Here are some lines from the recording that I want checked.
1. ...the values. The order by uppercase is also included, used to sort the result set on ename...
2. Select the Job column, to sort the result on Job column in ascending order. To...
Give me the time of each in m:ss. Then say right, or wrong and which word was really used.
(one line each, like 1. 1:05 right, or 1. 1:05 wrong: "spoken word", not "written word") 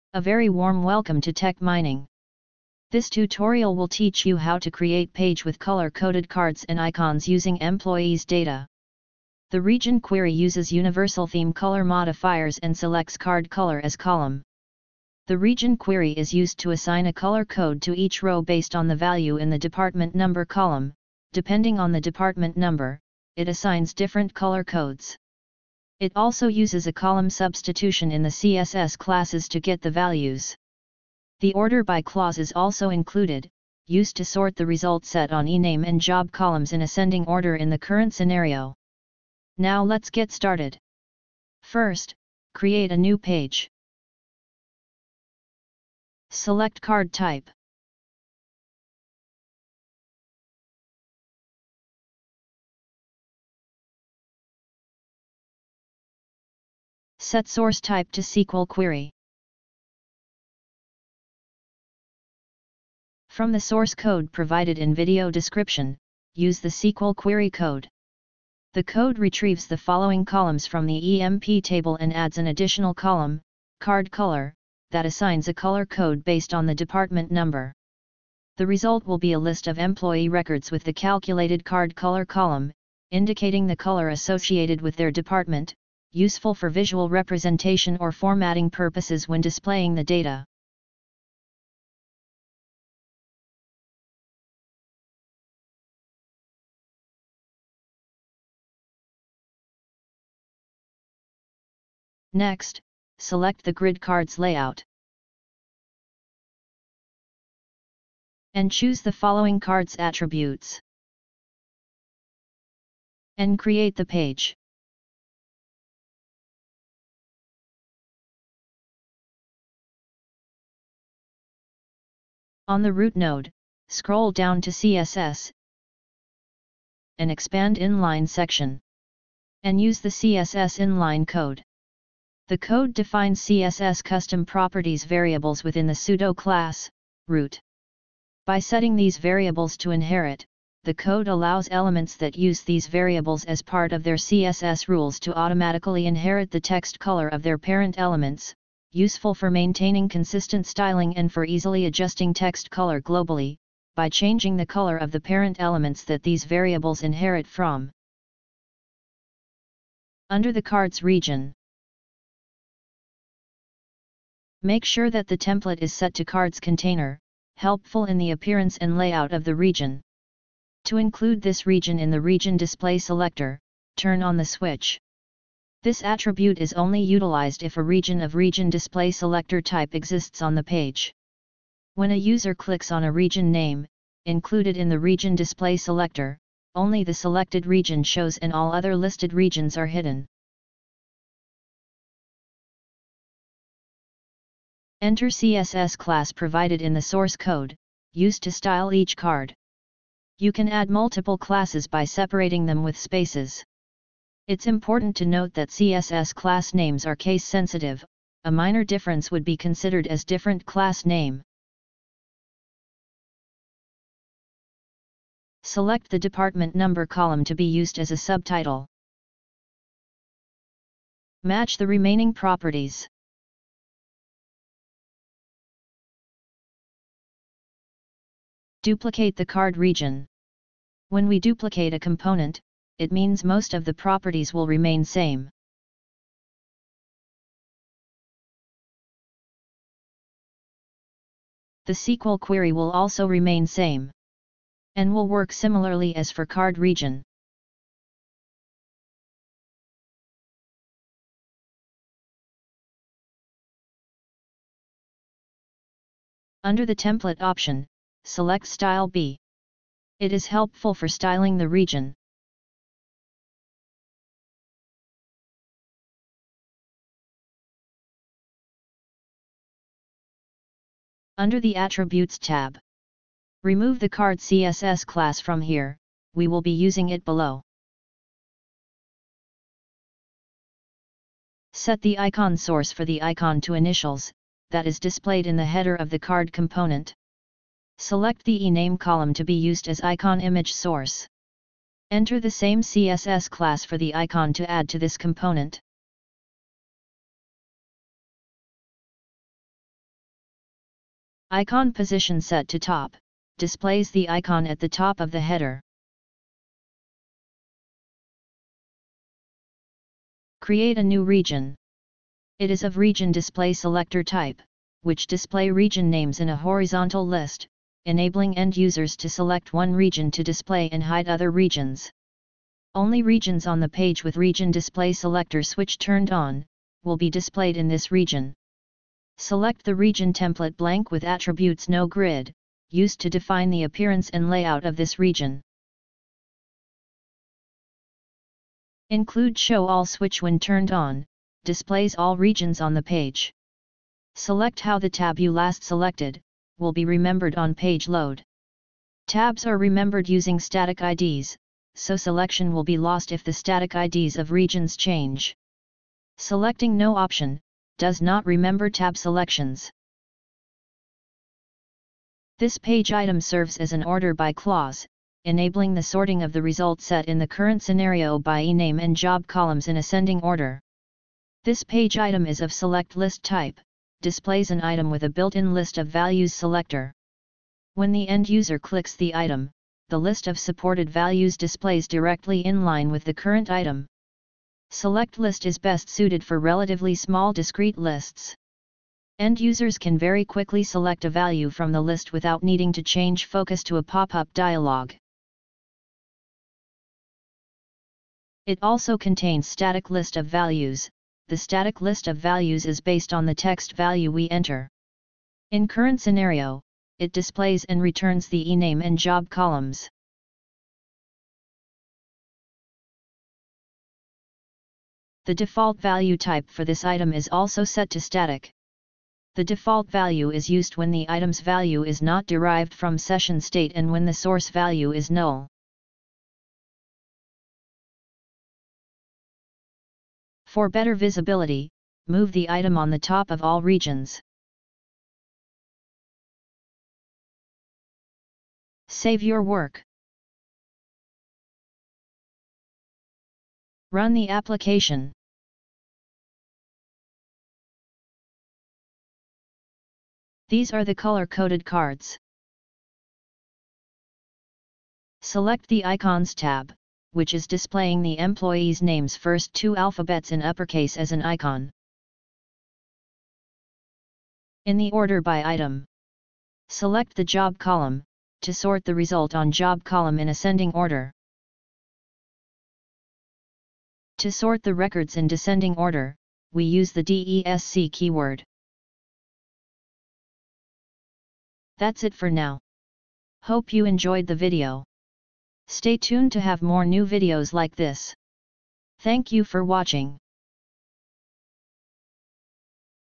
1. 0:29 wrong: "clause", not "uppercase"
2. 7:46 right.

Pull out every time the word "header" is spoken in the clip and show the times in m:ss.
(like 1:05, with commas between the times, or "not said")
4:45, 5:05.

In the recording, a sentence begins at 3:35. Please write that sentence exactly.
Select the department number column to be used as a subtitle.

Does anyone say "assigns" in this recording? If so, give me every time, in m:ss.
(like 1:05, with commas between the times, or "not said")
0:16, 0:23, 1:15.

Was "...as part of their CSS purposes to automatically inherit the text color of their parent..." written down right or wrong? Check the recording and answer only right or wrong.
wrong.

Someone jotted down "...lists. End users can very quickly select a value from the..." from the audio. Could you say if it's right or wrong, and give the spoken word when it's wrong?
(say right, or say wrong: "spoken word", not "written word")
right.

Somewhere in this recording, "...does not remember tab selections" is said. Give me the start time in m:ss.
5:58.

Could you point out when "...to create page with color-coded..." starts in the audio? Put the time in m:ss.
0:04.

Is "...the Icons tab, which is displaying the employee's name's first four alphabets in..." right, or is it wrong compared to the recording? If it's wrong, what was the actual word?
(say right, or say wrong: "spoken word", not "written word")
wrong: "two", not "four".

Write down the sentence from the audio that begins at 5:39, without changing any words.
Include Show All switch when turned on, displays all regions on the page.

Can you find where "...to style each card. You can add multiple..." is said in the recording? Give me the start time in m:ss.
3:18.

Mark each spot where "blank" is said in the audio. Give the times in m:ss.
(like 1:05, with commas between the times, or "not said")
5:30.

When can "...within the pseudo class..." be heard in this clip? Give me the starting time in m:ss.
2:15.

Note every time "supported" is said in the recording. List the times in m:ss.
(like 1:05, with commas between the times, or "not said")
6:20.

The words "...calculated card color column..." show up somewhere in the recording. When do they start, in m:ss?
1:20.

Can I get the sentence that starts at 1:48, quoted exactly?
And choose the following card's attributes.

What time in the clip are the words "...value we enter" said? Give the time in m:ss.
6:43.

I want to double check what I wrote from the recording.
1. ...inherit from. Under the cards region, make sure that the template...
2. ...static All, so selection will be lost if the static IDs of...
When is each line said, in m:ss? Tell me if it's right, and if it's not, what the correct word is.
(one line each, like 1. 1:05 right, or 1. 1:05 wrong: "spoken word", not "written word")
1. 2:37 right
2. 5:50 wrong: "IDs", not "All".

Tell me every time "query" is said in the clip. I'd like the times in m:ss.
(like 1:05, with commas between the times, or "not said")
0:10, 0:15, 0:58, 1:07, 4:02.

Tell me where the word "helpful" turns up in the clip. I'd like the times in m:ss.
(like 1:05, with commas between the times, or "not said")
2:47, 4:20.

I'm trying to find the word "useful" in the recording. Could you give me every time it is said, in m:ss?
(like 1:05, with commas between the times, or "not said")
1:26, 2:28.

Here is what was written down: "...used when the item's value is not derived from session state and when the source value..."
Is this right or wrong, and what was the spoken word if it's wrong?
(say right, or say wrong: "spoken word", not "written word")
right.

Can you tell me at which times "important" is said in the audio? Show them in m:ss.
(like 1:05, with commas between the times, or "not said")
3:24.